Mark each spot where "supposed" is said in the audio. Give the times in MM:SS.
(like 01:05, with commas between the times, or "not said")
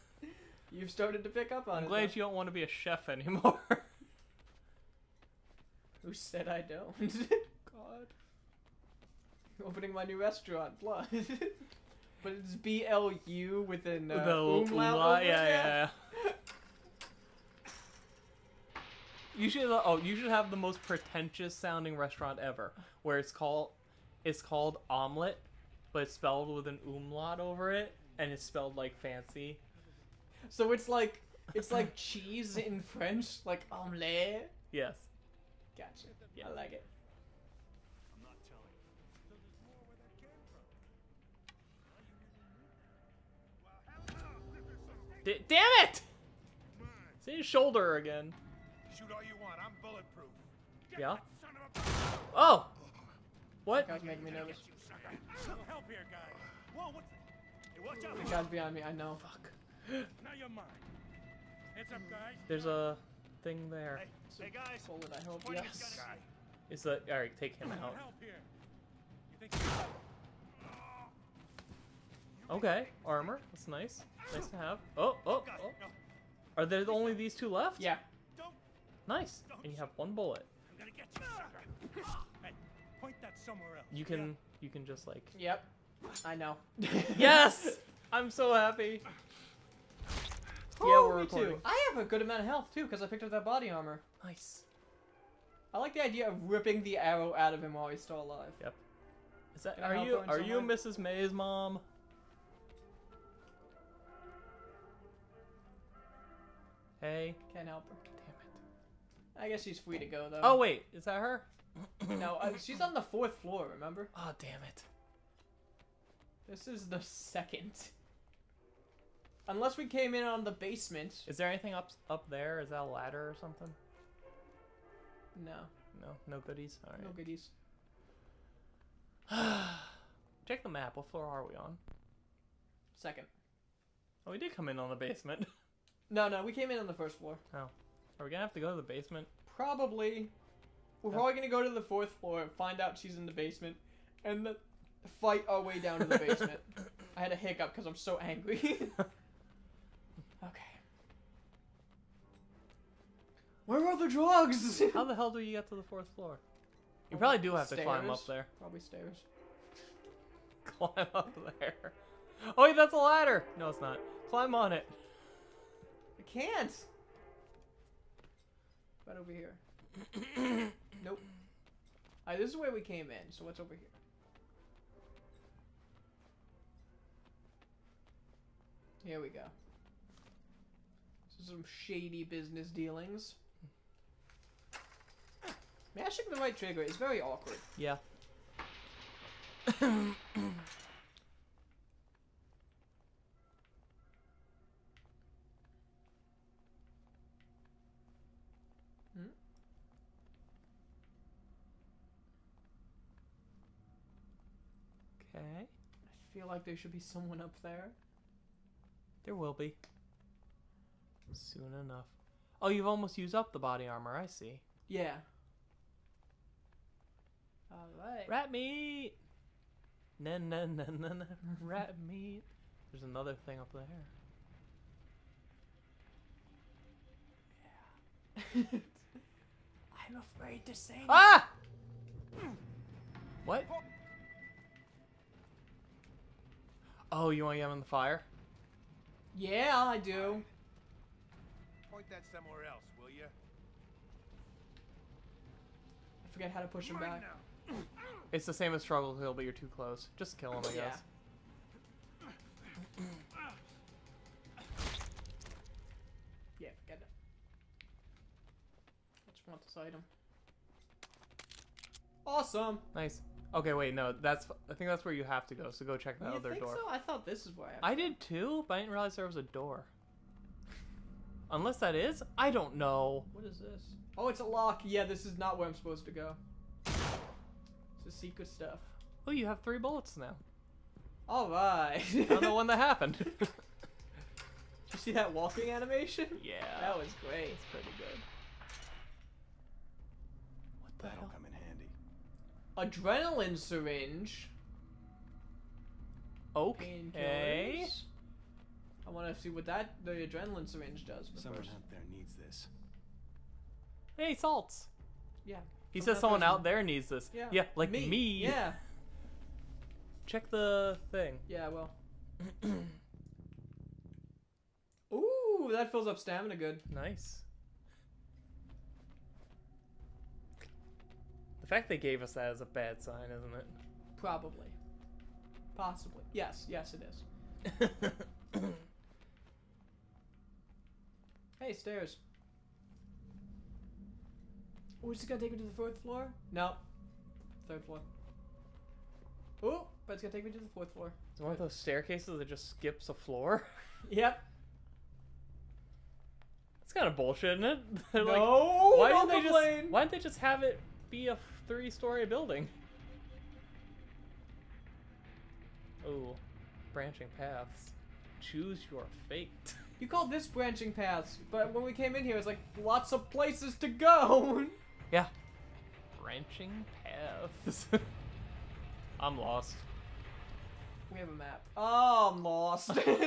04:35.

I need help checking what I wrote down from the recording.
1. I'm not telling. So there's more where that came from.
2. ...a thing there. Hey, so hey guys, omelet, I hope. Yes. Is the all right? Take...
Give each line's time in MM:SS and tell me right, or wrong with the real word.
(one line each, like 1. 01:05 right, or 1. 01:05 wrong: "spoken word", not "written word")
1. 00:38 right
2. 01:02 wrong: "bullet", not "omelet".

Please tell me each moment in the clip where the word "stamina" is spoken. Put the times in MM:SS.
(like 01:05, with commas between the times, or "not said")
05:16.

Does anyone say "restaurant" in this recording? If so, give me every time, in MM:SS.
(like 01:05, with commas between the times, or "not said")
00:10, 00:21.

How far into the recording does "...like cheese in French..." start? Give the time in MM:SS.
00:31.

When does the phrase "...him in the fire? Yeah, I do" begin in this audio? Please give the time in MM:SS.
03:57.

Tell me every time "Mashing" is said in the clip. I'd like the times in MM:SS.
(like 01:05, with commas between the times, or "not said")
03:05.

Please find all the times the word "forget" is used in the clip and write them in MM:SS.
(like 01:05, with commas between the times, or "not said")
04:06, 04:16.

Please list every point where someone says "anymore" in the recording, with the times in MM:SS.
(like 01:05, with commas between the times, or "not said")
00:03.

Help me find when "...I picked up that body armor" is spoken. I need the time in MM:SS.
01:33.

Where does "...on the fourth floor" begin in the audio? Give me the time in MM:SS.
01:52.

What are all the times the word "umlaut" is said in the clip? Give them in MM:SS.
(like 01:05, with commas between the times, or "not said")
00:14, 00:26.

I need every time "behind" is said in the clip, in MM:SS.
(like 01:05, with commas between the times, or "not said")
00:58.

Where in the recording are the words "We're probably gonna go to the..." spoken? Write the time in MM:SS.
02:21.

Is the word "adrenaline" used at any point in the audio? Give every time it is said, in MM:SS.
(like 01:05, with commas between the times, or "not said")
04:52, 05:00.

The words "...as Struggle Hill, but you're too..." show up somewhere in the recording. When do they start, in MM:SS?
04:08.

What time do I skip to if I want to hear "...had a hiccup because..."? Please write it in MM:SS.
02:27.